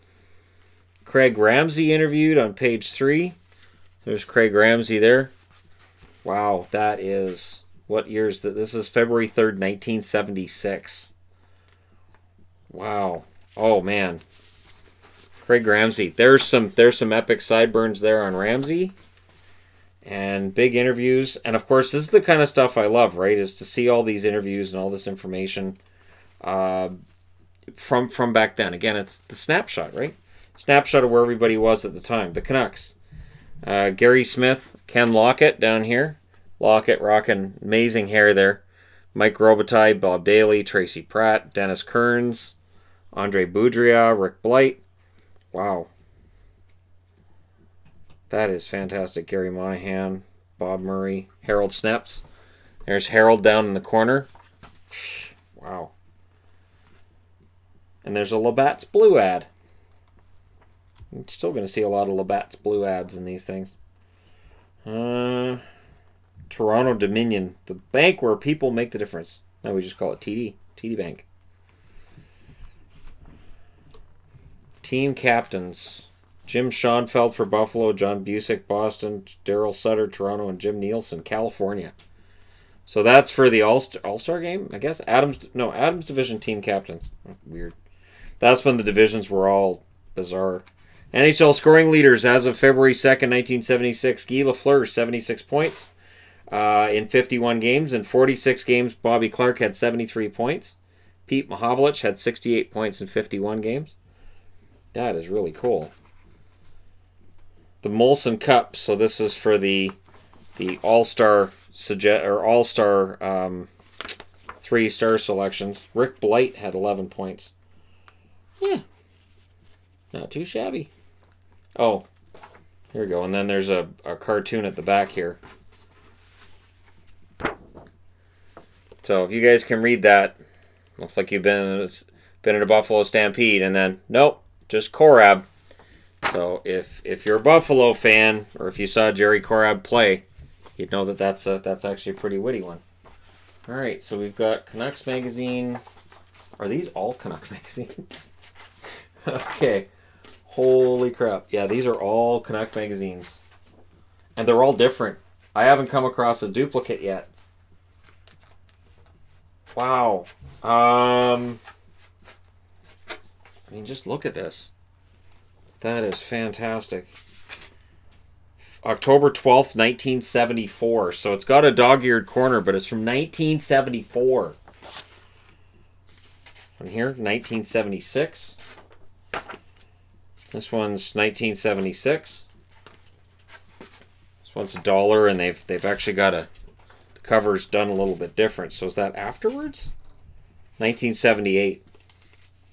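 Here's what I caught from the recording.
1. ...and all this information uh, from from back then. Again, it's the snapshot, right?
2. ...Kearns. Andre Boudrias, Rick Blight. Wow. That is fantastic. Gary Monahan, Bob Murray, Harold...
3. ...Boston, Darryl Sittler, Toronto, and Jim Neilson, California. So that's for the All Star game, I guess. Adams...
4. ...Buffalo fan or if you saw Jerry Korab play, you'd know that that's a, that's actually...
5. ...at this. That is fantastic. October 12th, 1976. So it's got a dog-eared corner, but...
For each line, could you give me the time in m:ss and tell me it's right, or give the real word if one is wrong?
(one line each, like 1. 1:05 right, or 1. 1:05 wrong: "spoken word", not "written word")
1. 0:24 right
2. 0:41 right
3. 1:18 right
4. 2:17 right
5. 2:44 wrong: "1974", not "1976".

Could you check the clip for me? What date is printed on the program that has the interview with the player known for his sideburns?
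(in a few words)
February 3rd, 1976.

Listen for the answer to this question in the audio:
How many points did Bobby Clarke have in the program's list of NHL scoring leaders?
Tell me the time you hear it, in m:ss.
1:39.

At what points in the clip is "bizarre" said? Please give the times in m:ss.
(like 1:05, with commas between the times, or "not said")
1:30.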